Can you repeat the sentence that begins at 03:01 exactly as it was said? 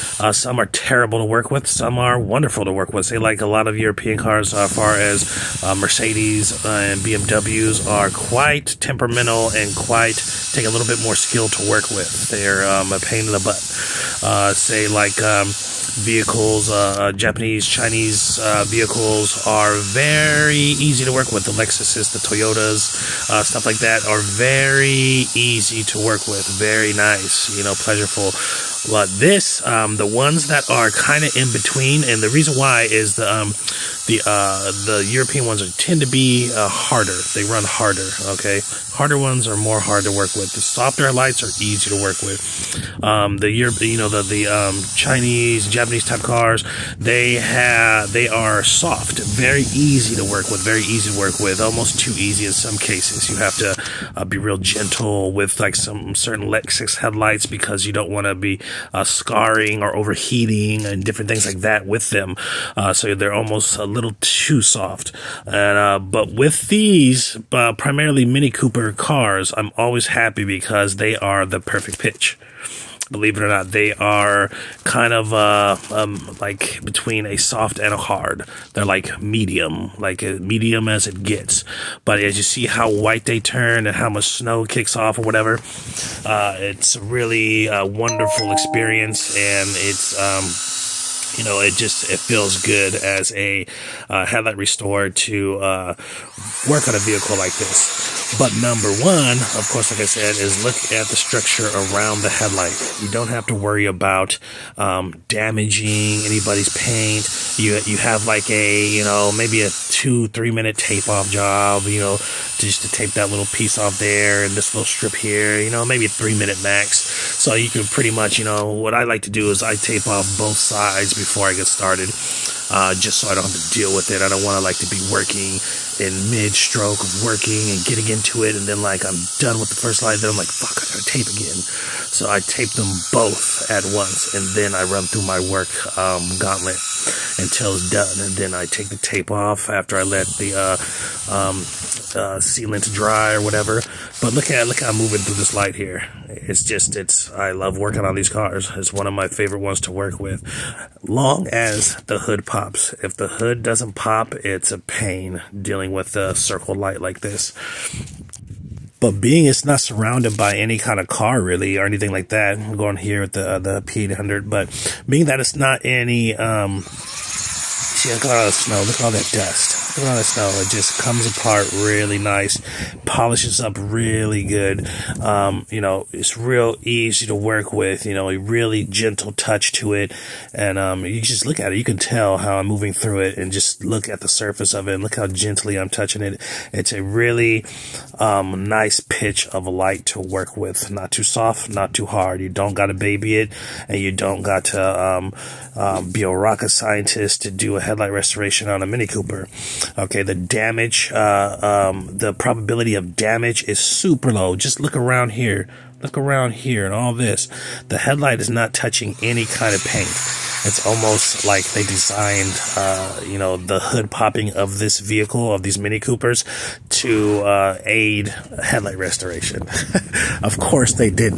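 You can tell how I'm moving through it, and just look at the surface of it.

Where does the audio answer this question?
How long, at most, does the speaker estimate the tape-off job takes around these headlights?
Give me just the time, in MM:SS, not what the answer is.
01:56.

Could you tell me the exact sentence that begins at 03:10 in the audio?
Not too soft, not too hard.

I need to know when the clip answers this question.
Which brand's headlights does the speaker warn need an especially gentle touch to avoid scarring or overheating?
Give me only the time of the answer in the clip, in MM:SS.
00:56.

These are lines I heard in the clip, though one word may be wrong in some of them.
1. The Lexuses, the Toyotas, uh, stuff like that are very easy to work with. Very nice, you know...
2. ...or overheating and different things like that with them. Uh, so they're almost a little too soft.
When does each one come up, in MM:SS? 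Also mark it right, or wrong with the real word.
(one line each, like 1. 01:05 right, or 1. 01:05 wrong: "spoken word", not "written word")
1. 00:21 right
2. 00:59 right.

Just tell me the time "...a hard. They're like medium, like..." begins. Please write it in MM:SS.
01:17.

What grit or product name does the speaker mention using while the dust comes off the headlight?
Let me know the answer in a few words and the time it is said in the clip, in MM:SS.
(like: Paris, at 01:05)
P800, at 02:43.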